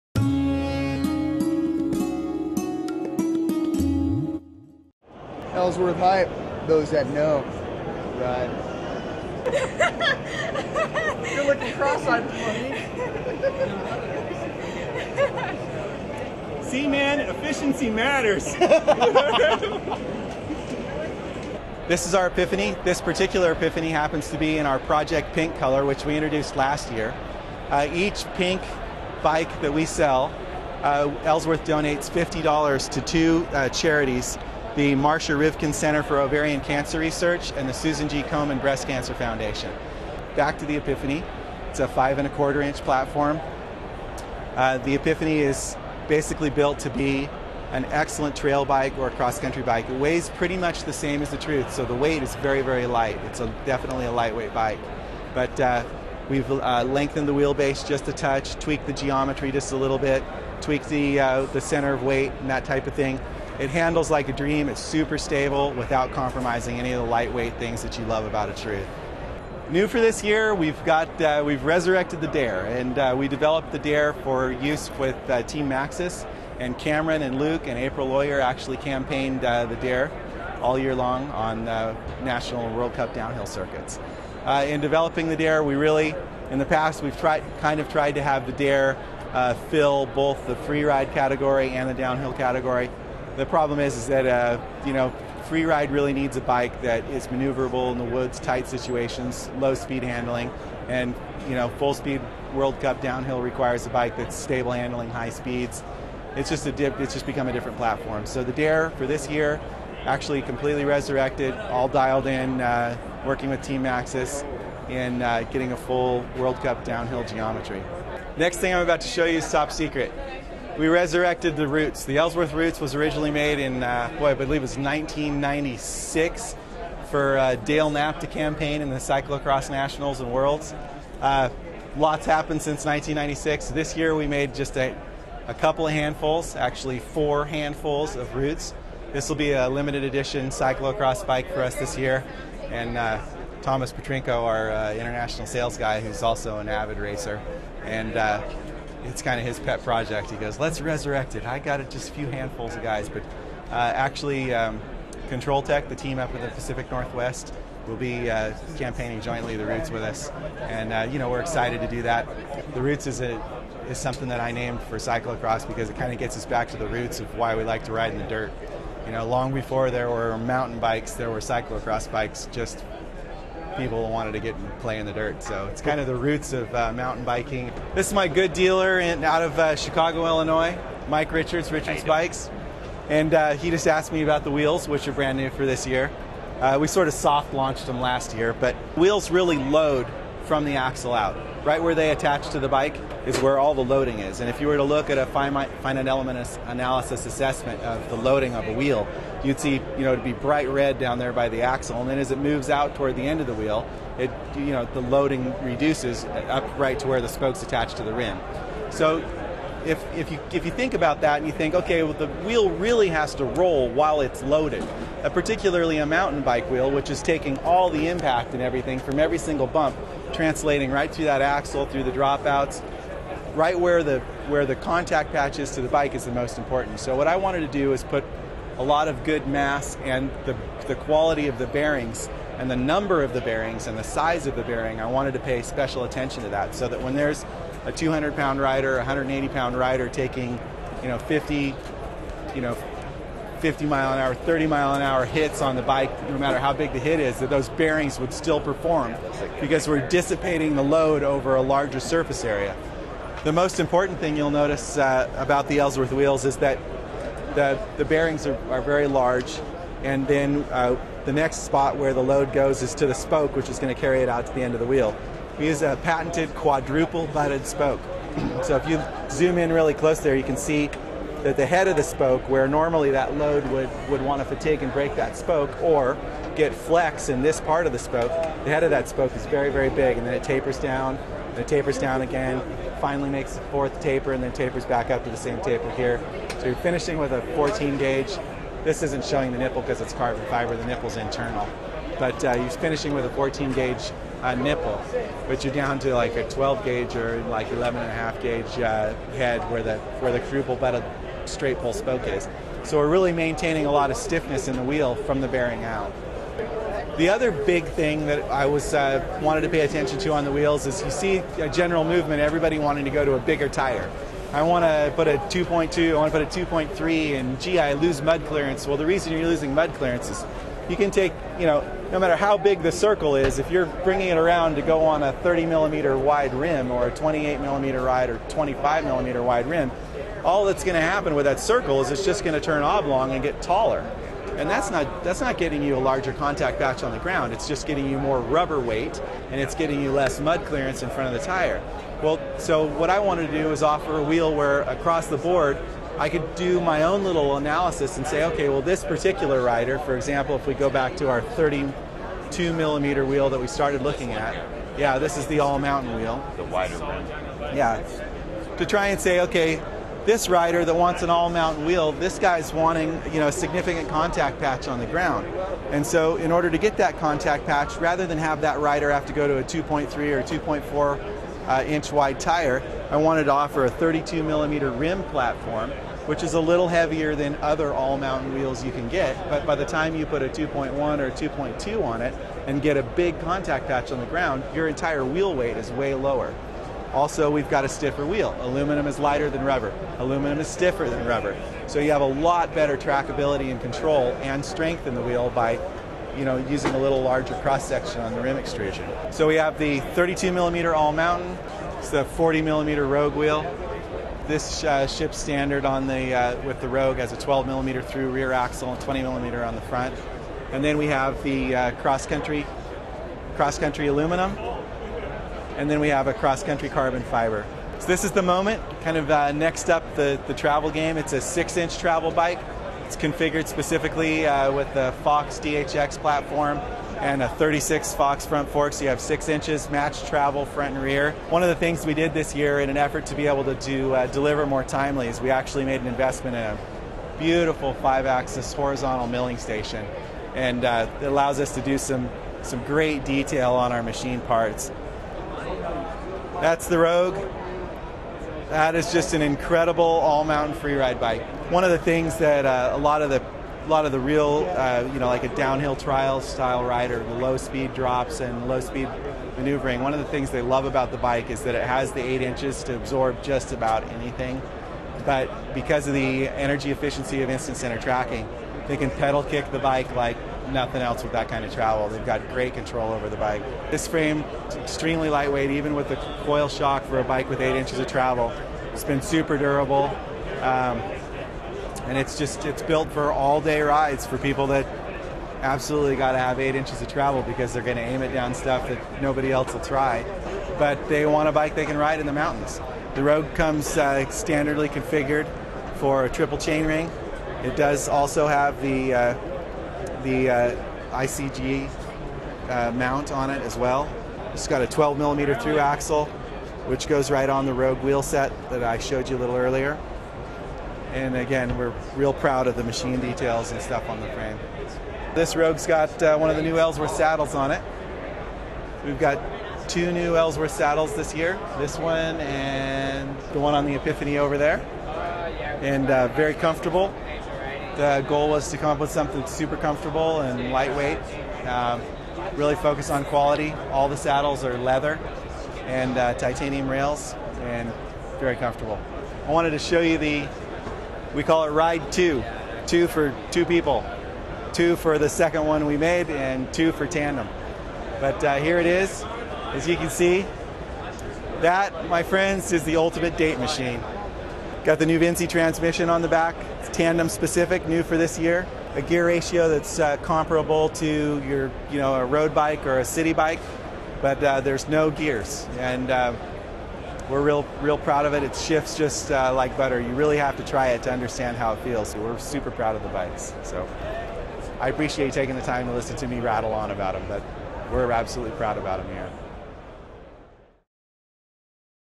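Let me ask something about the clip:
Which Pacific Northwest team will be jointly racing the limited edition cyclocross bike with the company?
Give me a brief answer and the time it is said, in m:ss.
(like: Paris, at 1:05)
Control Tech, at 2:35.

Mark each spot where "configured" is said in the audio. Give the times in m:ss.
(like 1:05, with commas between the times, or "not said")
7:03, 8:14.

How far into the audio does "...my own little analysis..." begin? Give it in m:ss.
5:46.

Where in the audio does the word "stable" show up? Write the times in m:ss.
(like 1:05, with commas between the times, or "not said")
1:05, 1:44.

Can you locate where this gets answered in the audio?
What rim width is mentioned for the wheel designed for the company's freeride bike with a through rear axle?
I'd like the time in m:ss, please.
6:42.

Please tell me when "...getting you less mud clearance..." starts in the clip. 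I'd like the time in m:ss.
5:39.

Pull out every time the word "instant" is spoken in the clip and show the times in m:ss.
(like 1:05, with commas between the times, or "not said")
7:47.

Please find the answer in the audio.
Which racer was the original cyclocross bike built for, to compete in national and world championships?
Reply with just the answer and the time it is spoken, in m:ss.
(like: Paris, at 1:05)
Dale Knapp, at 2:07.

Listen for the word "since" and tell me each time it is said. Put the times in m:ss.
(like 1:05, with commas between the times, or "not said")
2:12.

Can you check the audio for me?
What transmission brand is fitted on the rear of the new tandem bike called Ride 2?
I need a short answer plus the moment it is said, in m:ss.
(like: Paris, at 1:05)
NuVinci, at 9:15.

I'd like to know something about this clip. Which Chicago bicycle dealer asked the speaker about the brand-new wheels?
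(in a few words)
Mike Richards.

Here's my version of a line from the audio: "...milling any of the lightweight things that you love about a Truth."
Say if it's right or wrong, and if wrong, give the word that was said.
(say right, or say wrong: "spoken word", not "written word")
wrong: "compromising", not "milling".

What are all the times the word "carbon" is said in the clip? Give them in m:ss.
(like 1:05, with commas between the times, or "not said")
4:50, 6:56.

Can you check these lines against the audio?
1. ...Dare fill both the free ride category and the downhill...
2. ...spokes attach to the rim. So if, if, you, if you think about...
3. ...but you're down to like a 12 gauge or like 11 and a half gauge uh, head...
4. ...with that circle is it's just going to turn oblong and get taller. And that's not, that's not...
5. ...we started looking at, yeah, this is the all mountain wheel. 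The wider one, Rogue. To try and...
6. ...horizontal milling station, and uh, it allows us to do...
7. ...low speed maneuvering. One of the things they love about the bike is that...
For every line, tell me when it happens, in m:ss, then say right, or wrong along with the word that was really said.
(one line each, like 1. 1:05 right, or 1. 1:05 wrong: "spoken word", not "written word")
1. 1:28 right
2. 3:27 right
3. 4:55 right
4. 5:31 right
5. 5:53 wrong: "Yeah", not "Rogue"
6. 7:18 right
7. 7:38 right.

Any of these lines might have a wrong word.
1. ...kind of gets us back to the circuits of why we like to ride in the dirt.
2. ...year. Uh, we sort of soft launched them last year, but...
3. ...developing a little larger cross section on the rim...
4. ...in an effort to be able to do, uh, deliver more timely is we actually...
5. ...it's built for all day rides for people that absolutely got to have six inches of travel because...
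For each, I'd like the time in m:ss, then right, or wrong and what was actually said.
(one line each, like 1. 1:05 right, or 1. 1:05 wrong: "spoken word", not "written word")
1. 2:45 wrong: "roots", not "circuits"
2. 3:05 right
3. 6:36 wrong: "using", not "developing"
4. 7:12 right
5. 8:02 wrong: "eight", not "six".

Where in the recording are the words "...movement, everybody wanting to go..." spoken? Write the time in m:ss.
5:12.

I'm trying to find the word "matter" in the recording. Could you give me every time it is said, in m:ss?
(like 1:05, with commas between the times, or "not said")
0:17, 4:06, 5:22.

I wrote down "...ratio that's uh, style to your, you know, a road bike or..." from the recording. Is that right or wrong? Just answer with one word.
wrong.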